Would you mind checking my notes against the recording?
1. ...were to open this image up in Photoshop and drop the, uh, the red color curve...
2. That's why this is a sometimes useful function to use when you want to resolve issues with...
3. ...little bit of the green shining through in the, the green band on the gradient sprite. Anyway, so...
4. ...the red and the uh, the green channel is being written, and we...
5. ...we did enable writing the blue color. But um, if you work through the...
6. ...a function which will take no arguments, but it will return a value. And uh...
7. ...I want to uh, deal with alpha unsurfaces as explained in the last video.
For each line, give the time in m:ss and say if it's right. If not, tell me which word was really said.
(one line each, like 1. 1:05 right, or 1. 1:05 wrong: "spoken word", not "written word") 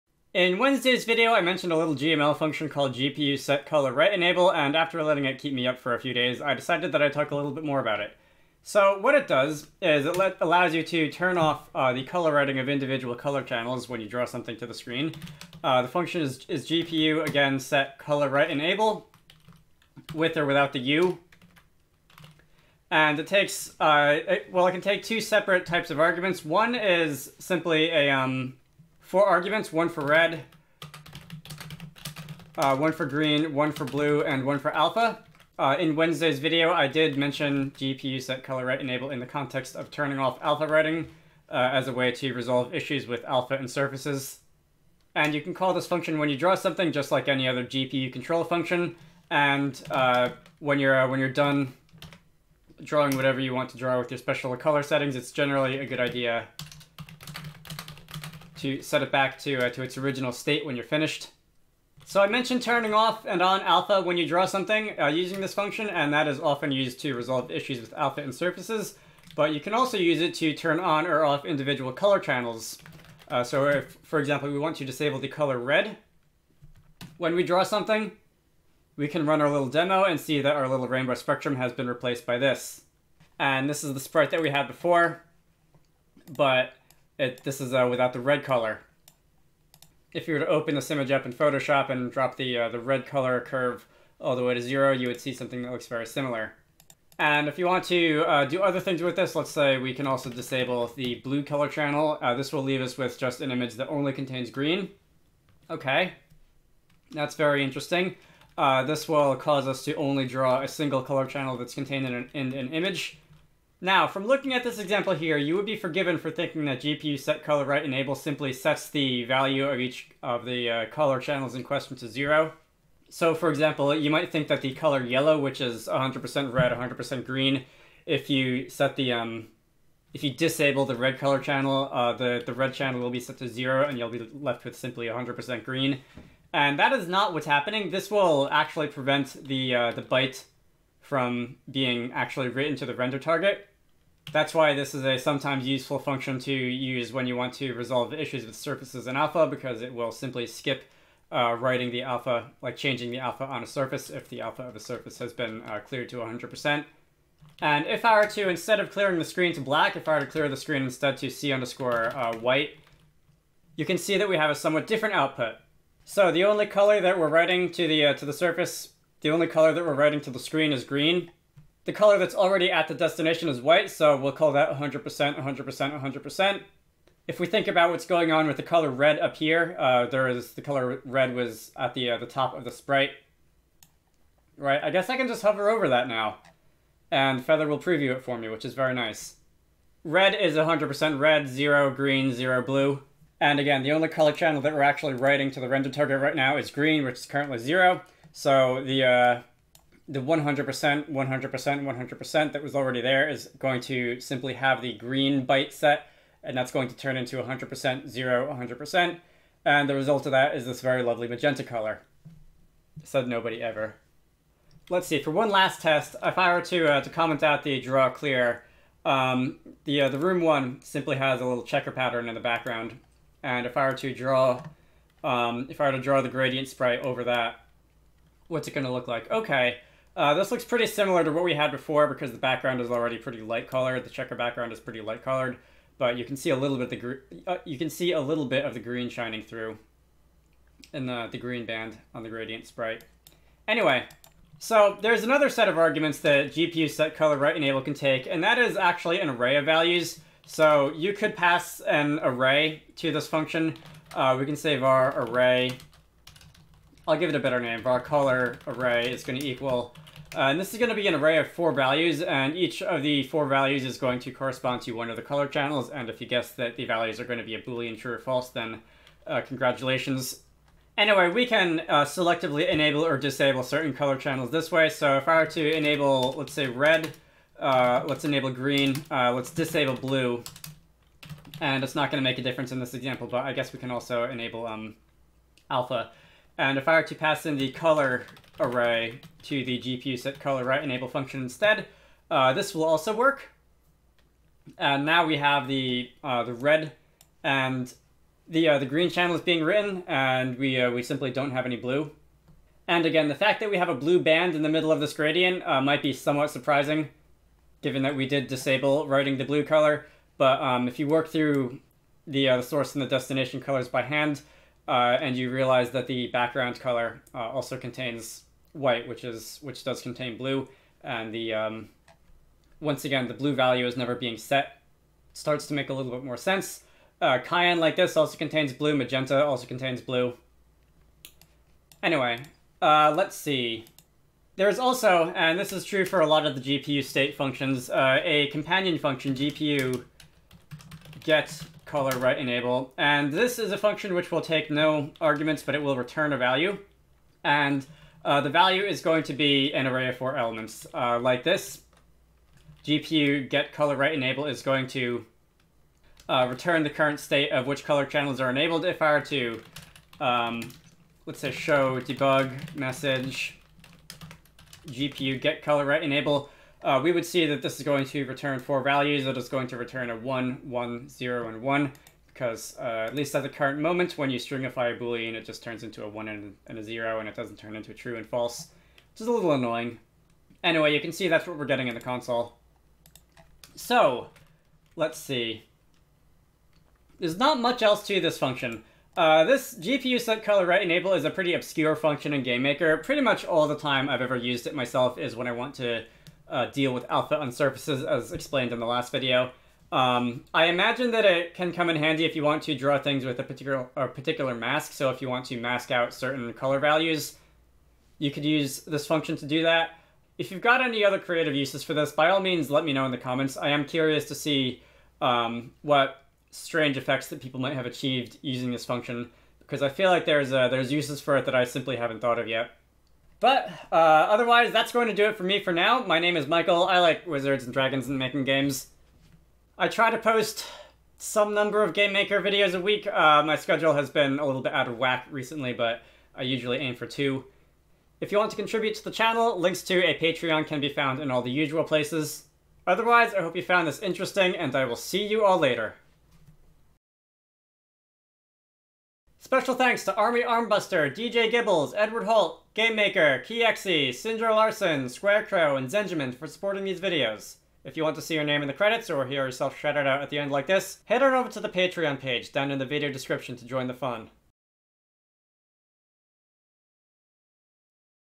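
1. 1:30 right
2. 2:24 right
3. 3:58 right
4. 4:56 right
5. 5:08 wrong: "disable", not "enable"
6. 5:43 right
7. 6:35 right.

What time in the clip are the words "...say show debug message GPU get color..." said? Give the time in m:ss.
6:01.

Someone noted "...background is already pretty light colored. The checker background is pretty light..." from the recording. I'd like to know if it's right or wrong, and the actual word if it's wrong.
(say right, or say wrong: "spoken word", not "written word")
right.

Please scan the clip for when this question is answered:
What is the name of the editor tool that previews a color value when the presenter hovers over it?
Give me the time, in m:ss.
3:07.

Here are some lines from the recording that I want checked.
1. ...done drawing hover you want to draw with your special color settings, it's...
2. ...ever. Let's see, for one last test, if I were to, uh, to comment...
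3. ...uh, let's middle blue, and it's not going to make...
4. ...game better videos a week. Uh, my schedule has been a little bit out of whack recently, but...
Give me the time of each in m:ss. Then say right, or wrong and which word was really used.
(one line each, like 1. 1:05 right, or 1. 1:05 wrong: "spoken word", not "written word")
1. 0:51 wrong: "whatever", not "hover"
2. 3:33 right
3. 4:39 wrong: "disable", not "middle"
4. 7:11 wrong: "maker", not "better".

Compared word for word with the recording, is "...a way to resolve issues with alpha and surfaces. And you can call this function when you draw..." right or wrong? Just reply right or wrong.
right.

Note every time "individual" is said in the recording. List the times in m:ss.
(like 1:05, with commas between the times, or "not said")
0:12, 1:11.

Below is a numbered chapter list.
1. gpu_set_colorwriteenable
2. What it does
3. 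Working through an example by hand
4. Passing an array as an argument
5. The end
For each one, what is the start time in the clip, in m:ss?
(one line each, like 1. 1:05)
1. 0:10
2. 1:01
3. 2:57
4. 4:04
5. 6:26.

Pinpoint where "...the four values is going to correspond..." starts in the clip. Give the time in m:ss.
4:23.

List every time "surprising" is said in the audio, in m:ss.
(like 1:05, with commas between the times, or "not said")
5:06.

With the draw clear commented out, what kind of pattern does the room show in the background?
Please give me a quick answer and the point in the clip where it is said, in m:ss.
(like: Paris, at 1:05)
Checker pattern, at 3:41.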